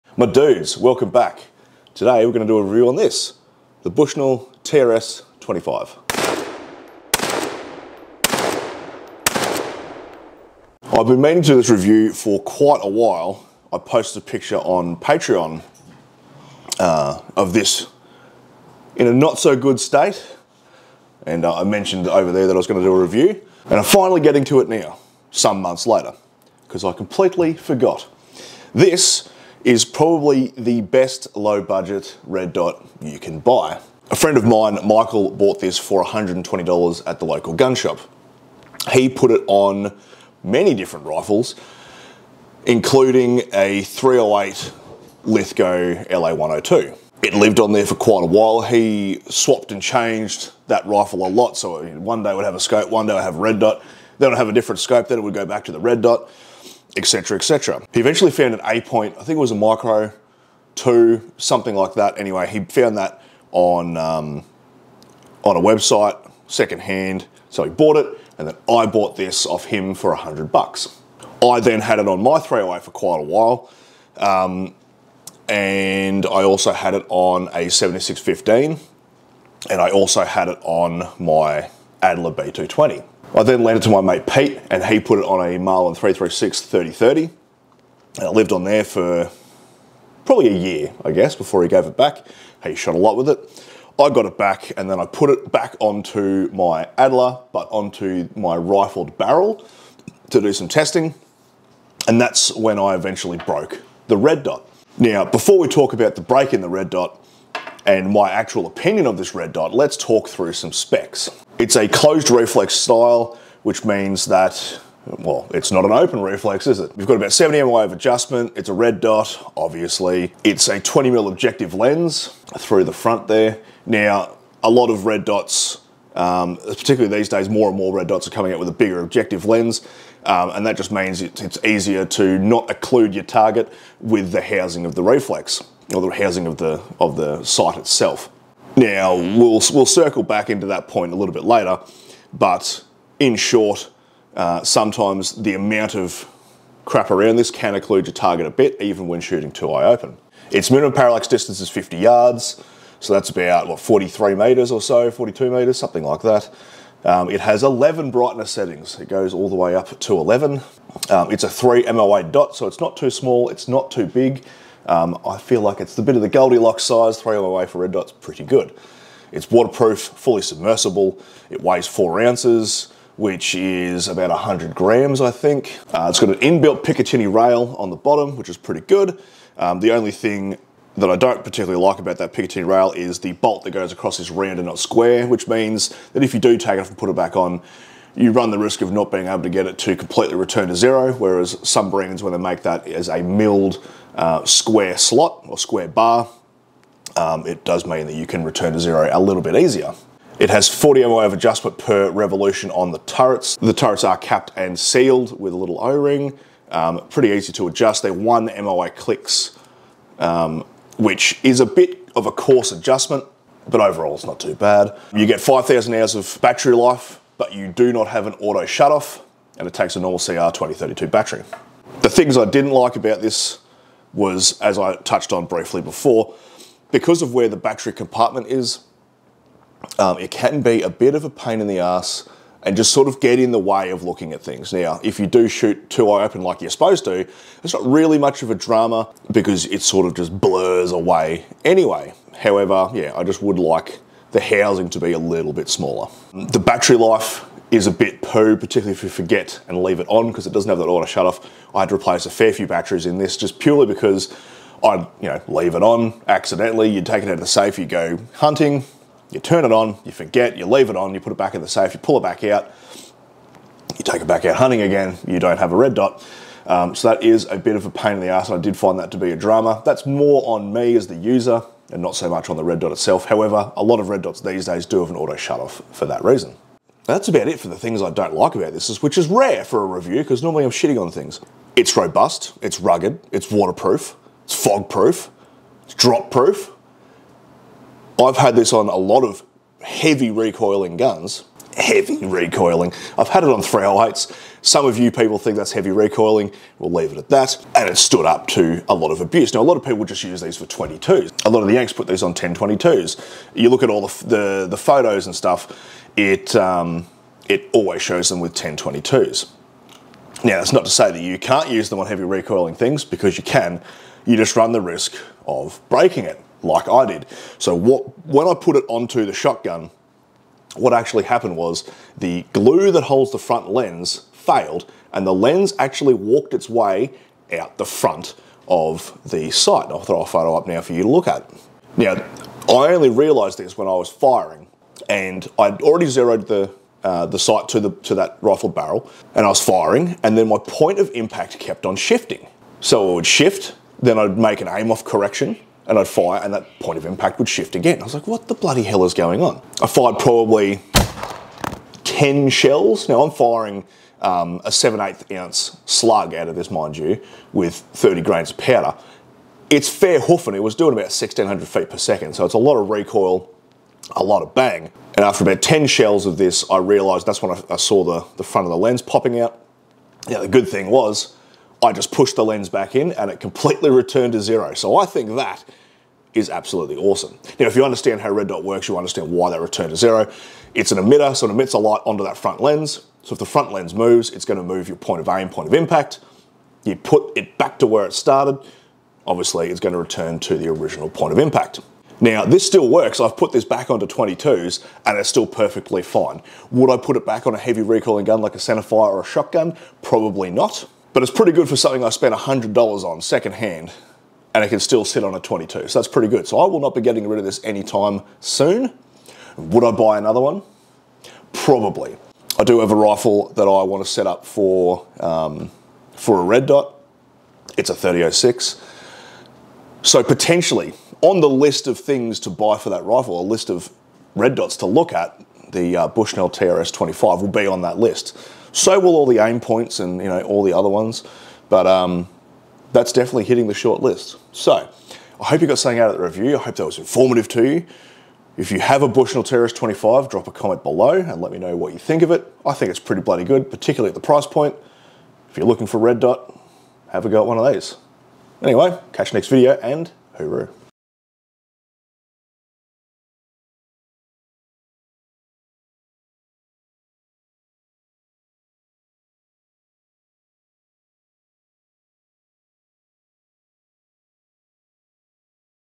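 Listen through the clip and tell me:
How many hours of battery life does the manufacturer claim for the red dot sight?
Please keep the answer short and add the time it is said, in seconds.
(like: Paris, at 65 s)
5,000 hours, at 215 s.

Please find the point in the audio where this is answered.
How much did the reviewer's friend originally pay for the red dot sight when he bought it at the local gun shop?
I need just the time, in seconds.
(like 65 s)
36 s.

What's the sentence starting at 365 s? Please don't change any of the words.
And after about 10 shells of this, I realized that's when I, I saw the, the front of the lens popping out.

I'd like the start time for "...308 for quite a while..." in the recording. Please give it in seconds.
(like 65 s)
72 s.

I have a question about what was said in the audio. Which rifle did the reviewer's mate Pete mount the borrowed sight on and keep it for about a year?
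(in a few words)
Marlin 336 3030.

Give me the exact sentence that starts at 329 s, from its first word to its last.
I'll throw a photo up now for you to look at.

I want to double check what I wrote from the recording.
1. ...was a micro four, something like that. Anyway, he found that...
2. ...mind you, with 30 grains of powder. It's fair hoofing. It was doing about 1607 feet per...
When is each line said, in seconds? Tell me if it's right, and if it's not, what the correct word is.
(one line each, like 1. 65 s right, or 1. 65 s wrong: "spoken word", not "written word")
1. 59 s wrong: "two", not "four"
2. 356 s wrong: "1600", not "1607".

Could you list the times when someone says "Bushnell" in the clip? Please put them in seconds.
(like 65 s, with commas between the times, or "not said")
3 s, 426 s, 439 s.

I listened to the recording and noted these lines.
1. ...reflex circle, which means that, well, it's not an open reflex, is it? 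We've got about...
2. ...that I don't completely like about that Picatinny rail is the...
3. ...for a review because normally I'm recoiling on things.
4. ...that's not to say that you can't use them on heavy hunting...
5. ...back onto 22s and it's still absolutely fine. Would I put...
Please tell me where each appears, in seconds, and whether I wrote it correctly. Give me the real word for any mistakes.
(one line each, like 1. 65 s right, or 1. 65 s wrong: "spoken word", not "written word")
1. 112 s wrong: "style", not "circle"
2. 180 s wrong: "particularly", not "completely"
3. 279 s wrong: "shitting", not "recoiling"
4. 310 s wrong: "recoiling", not "hunting"
5. 393 s wrong: "perfectly", not "absolutely".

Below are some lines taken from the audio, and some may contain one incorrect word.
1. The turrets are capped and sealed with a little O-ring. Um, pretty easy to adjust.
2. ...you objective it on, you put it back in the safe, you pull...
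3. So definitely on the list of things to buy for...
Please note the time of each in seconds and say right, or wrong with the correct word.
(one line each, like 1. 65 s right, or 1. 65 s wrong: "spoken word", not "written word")
1. 203 s right
2. 260 s wrong: "leave", not "objective"
3. 420 s wrong: "potentially", not "definitely".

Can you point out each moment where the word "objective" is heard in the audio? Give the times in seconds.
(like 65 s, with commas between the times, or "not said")
121 s, 128 s.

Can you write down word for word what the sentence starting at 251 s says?
I had to replace a fair few batteries in this just purely because I'd you know leave it on accidentally.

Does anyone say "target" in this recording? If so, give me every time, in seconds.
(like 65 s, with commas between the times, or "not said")
133 s, 148 s.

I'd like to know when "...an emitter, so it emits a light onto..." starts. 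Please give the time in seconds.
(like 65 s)
380 s.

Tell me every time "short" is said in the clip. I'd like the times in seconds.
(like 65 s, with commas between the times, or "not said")
143 s, 433 s.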